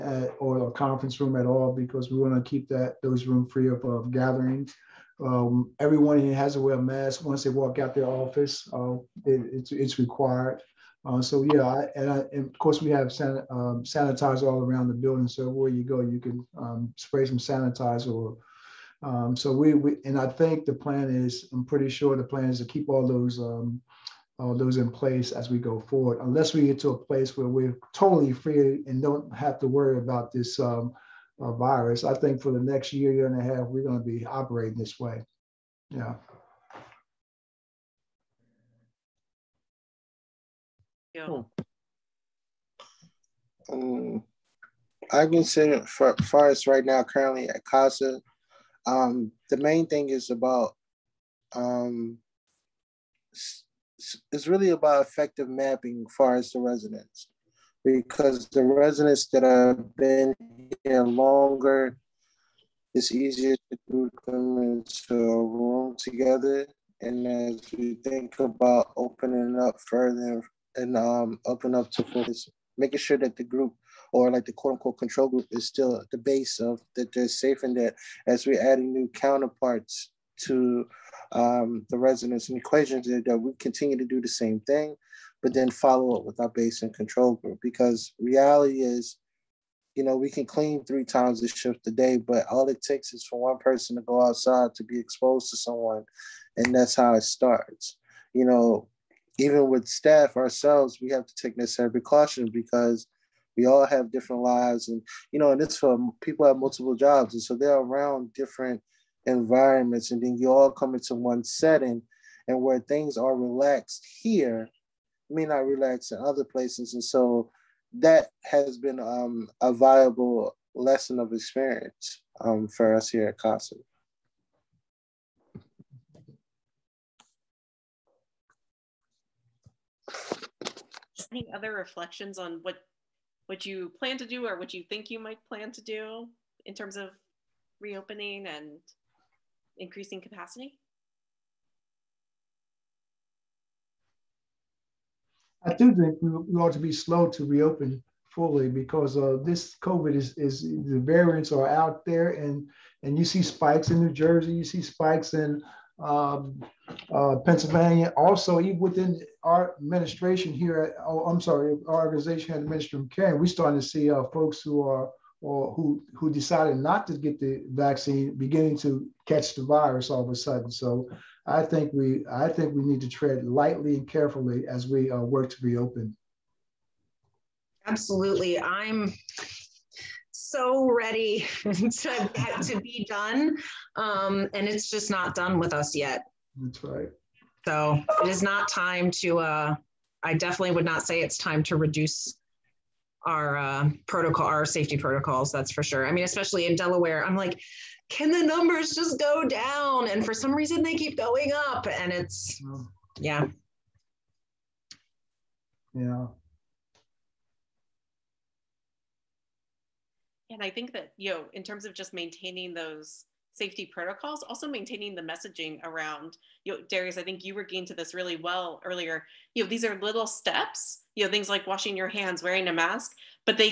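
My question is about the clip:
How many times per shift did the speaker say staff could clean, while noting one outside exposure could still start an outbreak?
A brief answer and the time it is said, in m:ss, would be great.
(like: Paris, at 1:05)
3, at 1:30.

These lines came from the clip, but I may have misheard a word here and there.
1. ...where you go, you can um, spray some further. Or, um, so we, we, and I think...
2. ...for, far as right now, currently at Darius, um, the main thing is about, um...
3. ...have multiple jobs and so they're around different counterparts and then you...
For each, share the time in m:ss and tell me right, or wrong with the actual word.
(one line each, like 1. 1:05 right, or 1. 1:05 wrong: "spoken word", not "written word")
1. 0:15 wrong: "sanitizer", not "further"
2. 0:45 wrong: "CASA", not "Darius"
3. 1:46 wrong: "environments", not "counterparts".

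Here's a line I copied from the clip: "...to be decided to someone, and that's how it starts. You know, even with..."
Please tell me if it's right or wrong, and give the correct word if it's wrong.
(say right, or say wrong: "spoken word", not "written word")
wrong: "exposed", not "decided".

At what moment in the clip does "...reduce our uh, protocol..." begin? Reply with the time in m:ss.
3:11.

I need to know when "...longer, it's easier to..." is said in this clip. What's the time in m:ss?
1:01.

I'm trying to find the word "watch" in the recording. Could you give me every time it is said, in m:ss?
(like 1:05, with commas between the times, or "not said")
not said.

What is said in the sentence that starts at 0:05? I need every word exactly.
Um, everyone here has to wear a mask once they walk out their office.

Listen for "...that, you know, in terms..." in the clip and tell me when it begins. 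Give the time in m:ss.
3:30.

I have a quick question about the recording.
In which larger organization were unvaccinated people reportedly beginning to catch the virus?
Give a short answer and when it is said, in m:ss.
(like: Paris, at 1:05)
the Ministry of Caring, at 2:42.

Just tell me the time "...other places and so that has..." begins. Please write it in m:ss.
1:56.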